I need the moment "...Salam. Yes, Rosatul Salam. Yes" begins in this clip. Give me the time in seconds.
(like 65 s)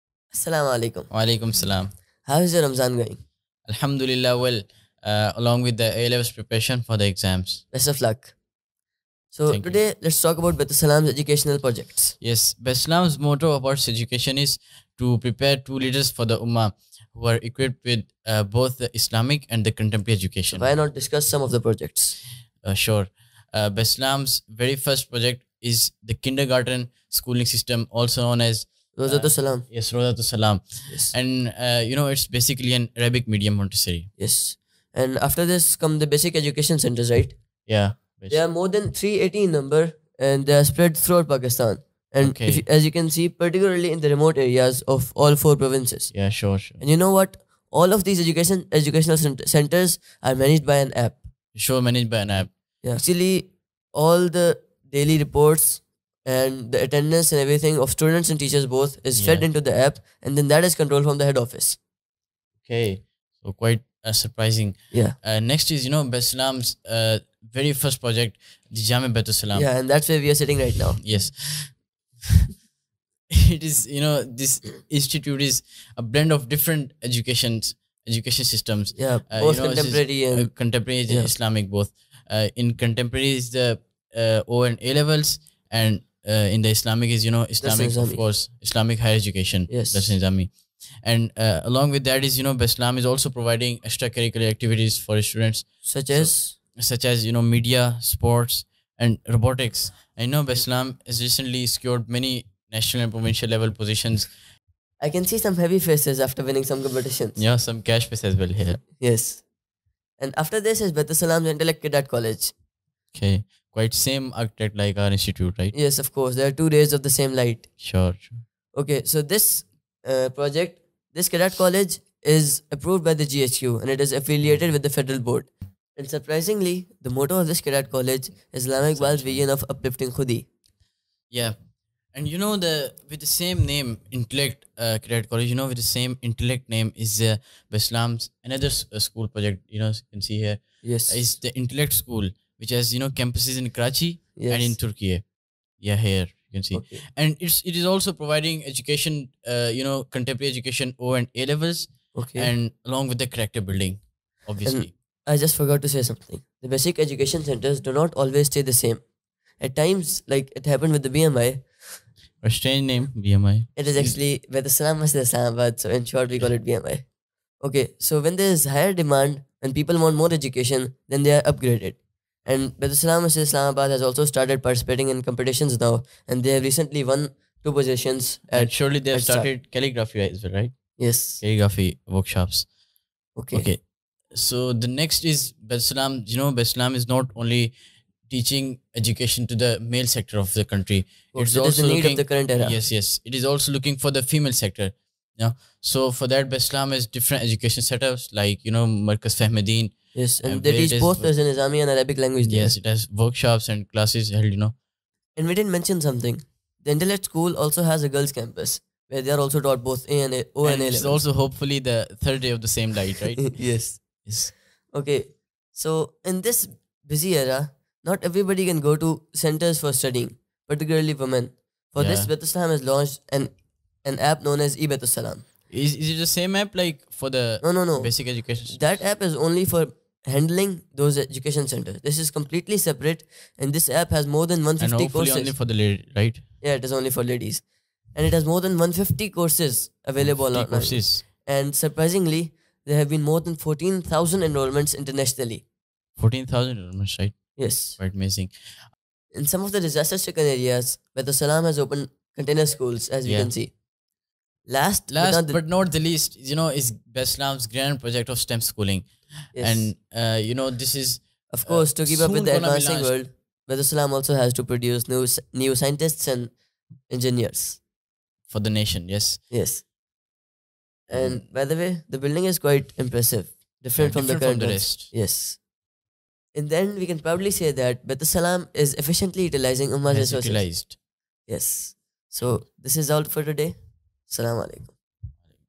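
29 s.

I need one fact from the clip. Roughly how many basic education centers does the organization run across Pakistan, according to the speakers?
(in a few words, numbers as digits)
More than 380.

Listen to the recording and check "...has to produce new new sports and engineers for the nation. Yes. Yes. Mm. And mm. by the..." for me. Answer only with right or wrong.
wrong.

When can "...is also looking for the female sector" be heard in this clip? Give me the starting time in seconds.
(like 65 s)
193 s.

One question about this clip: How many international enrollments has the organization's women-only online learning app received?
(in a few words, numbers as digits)
More than 14,000.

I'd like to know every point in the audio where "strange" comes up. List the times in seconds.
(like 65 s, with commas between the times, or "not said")
162 s.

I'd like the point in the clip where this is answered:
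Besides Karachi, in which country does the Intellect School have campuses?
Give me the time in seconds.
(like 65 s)
144 s.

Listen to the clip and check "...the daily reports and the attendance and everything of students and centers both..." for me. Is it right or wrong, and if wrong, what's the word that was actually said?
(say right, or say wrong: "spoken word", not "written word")
wrong: "teachers", not "centers".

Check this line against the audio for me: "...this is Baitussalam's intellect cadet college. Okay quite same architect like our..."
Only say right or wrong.
right.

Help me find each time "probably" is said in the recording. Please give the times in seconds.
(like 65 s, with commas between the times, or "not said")
277 s.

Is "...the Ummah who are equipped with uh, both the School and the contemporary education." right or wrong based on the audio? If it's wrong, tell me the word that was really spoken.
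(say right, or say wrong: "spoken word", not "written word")
wrong: "Islamic", not "School".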